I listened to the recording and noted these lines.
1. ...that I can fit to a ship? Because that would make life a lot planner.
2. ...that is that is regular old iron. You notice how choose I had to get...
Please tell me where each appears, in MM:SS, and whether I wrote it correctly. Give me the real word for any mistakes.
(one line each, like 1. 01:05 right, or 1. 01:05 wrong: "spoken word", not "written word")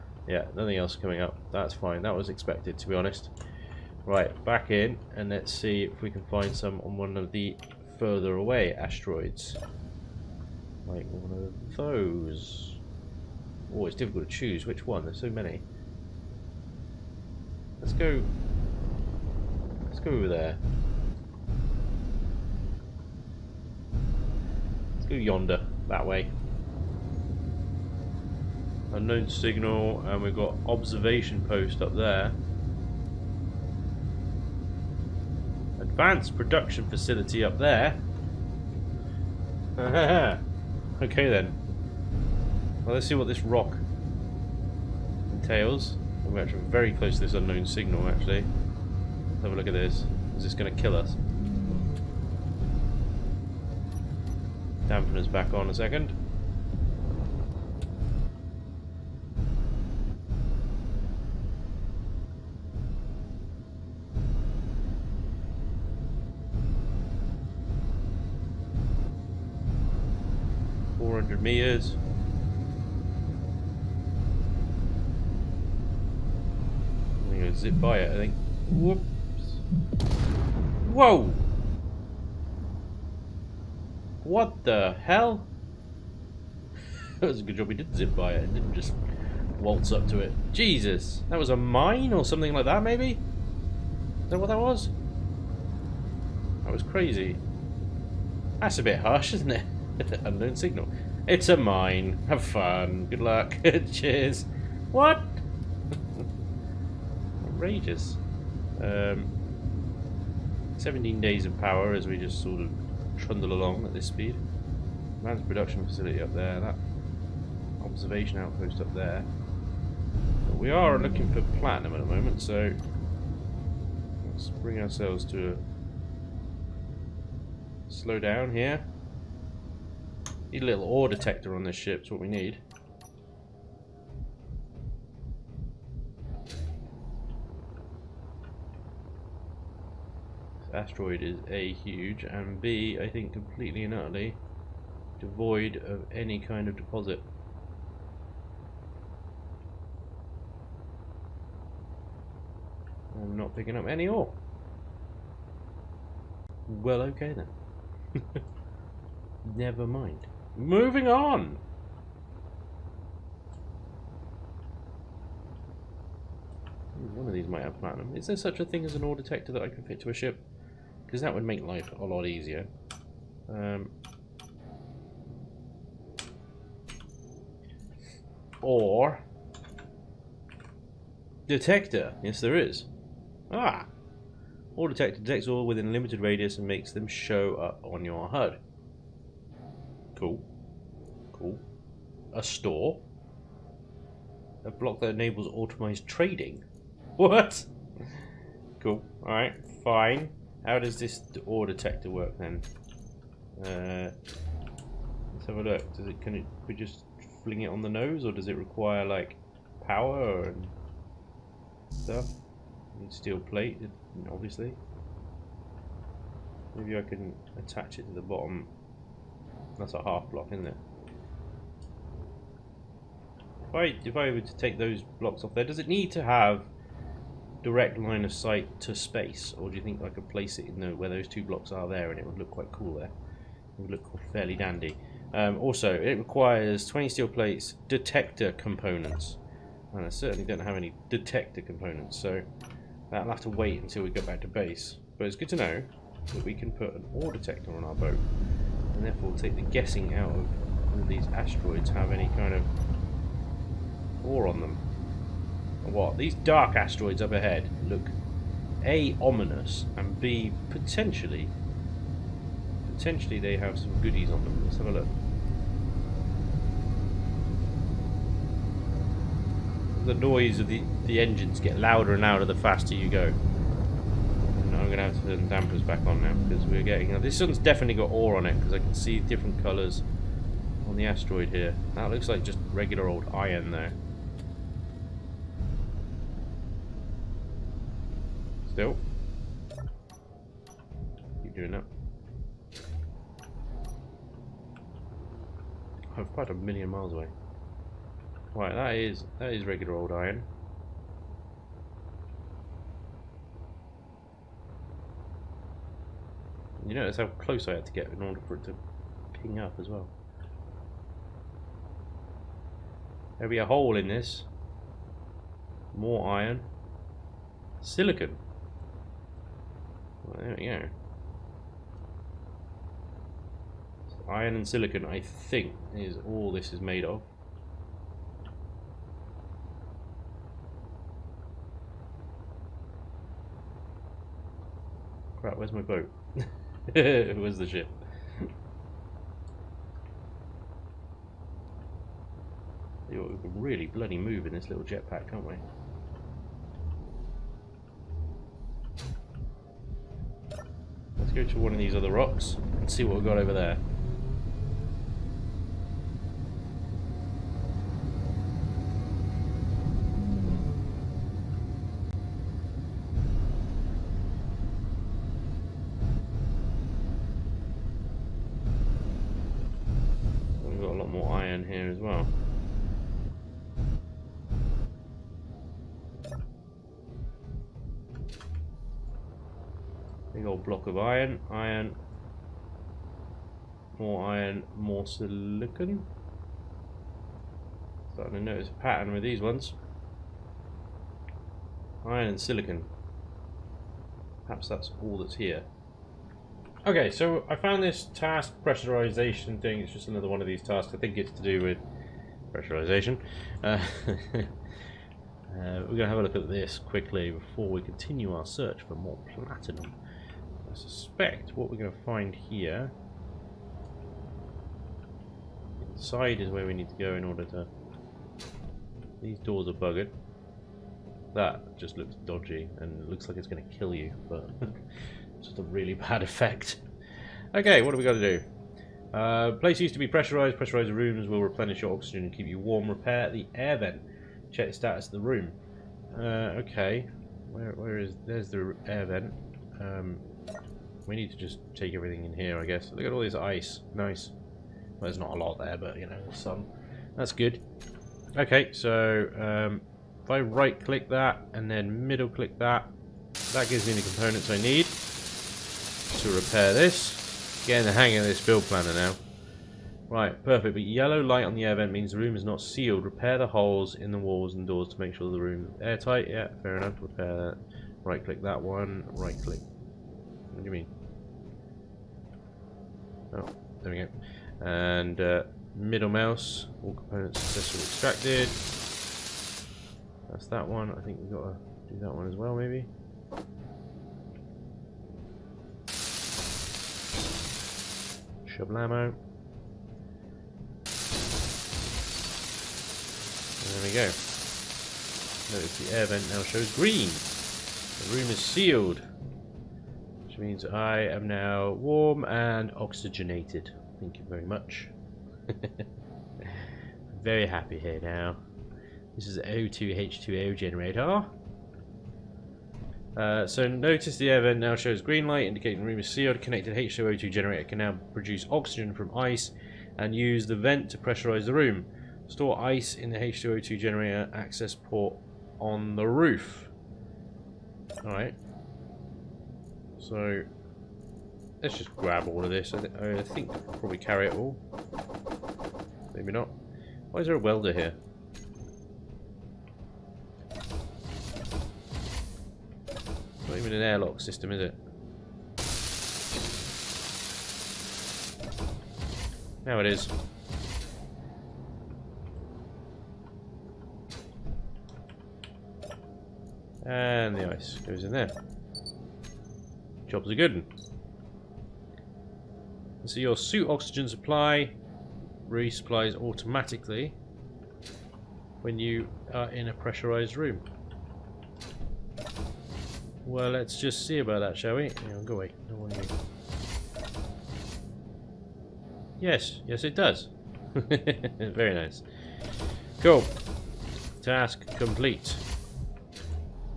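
1. 02:49 wrong: "easier", not "planner"
2. 04:58 wrong: "close", not "choose".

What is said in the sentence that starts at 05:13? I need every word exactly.
There'll be a hole in this.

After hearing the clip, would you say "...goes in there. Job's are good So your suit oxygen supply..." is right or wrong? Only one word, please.
right.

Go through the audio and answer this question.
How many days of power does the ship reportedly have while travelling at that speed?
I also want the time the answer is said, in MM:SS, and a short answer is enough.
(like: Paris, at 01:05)
17, at 01:50.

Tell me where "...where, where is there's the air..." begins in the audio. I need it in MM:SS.
07:17.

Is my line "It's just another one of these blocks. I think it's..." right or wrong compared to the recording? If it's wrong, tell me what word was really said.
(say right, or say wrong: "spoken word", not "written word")
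wrong: "tasks", not "blocks".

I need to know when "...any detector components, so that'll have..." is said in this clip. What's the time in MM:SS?
04:00.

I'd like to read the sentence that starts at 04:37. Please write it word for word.
Now this one's definitely got ore on it because I can see different colours on the asteroid here.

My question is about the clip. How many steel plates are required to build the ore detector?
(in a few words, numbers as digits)
20.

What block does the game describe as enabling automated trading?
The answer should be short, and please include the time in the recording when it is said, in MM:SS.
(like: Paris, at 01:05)
A store, at 03:12.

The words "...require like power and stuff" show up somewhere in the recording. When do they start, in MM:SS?
03:28.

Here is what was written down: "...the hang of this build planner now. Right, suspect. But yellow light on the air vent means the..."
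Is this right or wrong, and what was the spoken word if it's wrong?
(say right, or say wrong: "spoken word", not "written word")
wrong: "perfect", not "suspect".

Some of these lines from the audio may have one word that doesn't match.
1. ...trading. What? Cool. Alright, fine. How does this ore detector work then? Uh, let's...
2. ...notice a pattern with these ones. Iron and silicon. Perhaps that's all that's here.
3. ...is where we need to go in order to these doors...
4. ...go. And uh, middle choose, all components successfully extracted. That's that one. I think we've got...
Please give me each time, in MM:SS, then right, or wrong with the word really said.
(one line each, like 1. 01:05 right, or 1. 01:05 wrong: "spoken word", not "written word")
1. 03:16 right
2. 06:28 right
3. 06:56 right
4. 07:53 wrong: "mouse", not "choose".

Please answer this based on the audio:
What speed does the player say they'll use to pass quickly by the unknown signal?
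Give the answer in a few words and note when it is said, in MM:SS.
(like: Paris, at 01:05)
400, at 01:10.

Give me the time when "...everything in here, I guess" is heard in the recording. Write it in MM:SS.
07:21.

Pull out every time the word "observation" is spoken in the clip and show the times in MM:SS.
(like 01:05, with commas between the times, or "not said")
00:30, 01:57.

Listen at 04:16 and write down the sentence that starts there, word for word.
These dark asteroids up ahead look A, ominous, and B, potentially, potentially they have some goodies on them.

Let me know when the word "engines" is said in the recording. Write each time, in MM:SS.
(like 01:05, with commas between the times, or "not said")
04:31.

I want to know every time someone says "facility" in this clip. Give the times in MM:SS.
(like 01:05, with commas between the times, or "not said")
00:36, 01:55.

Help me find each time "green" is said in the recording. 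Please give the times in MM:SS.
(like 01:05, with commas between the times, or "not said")
08:16, 08:35.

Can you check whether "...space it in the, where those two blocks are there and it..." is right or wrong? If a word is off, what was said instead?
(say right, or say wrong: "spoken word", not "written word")
wrong: "place", not "space".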